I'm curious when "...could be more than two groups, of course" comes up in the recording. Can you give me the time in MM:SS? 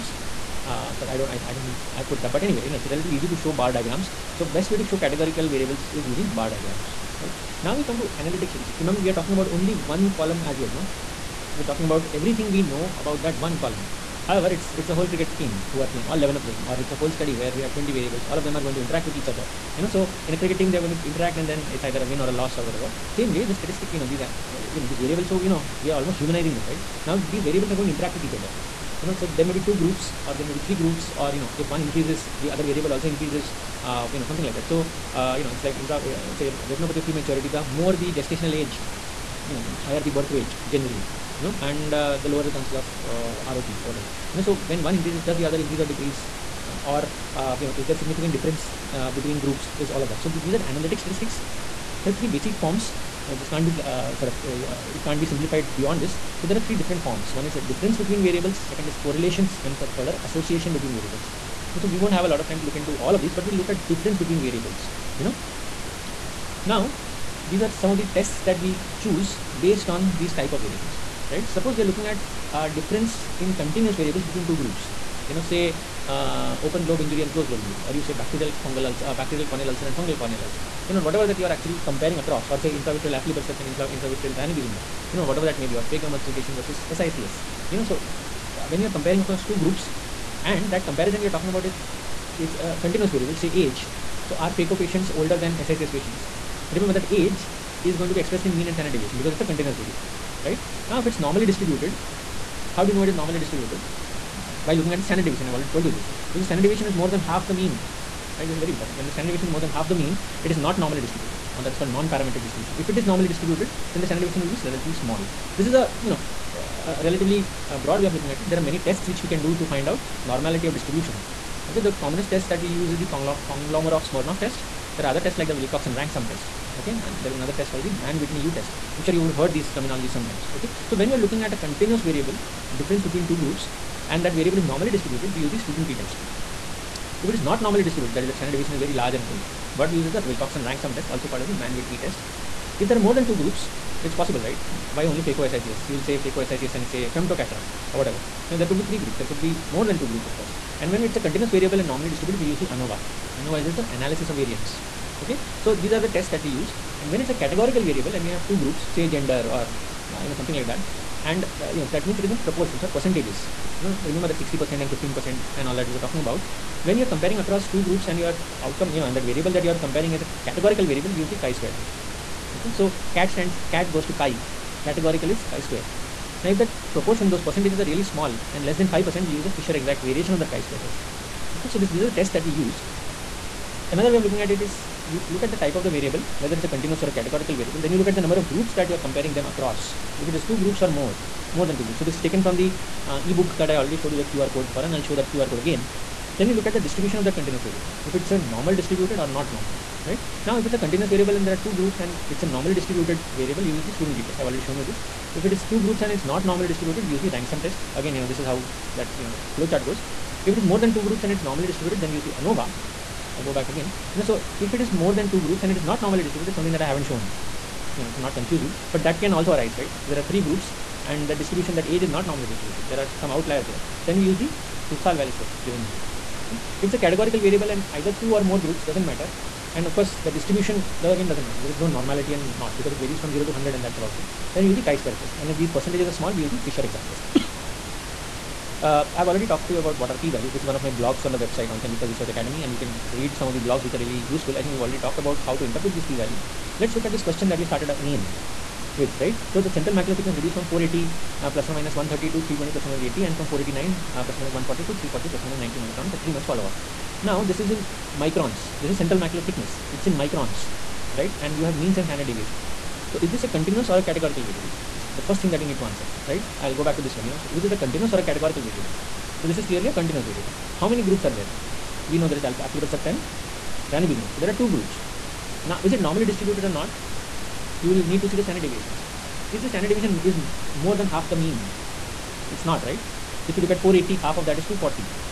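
02:29.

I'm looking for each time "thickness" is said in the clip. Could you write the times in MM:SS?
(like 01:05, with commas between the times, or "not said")
04:10, 04:19.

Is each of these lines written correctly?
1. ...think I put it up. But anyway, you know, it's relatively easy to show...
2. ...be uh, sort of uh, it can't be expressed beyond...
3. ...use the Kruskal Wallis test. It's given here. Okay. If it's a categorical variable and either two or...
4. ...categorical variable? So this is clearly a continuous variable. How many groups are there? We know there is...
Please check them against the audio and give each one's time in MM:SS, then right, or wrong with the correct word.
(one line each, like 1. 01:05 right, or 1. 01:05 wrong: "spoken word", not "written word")
1. 00:01 right
2. 00:53 wrong: "simplified", not "expressed"
3. 03:44 right
4. 04:28 right.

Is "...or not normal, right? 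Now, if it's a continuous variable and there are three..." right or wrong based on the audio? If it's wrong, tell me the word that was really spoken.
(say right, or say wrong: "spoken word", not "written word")
wrong: "two", not "three".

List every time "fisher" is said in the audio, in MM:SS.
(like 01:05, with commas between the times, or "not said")
02:59, 03:56.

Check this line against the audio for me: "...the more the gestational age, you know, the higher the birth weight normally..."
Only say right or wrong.
wrong.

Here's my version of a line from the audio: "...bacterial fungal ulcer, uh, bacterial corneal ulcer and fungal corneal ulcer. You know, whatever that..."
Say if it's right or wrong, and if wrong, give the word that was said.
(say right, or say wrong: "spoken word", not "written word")
right.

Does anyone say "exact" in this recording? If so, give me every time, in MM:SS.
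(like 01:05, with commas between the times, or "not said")
02:59, 03:56.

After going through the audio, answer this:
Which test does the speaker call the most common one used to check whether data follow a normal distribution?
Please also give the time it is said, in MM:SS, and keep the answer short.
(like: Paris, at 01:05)
Kolmogorov Smirnov test, at 02:03.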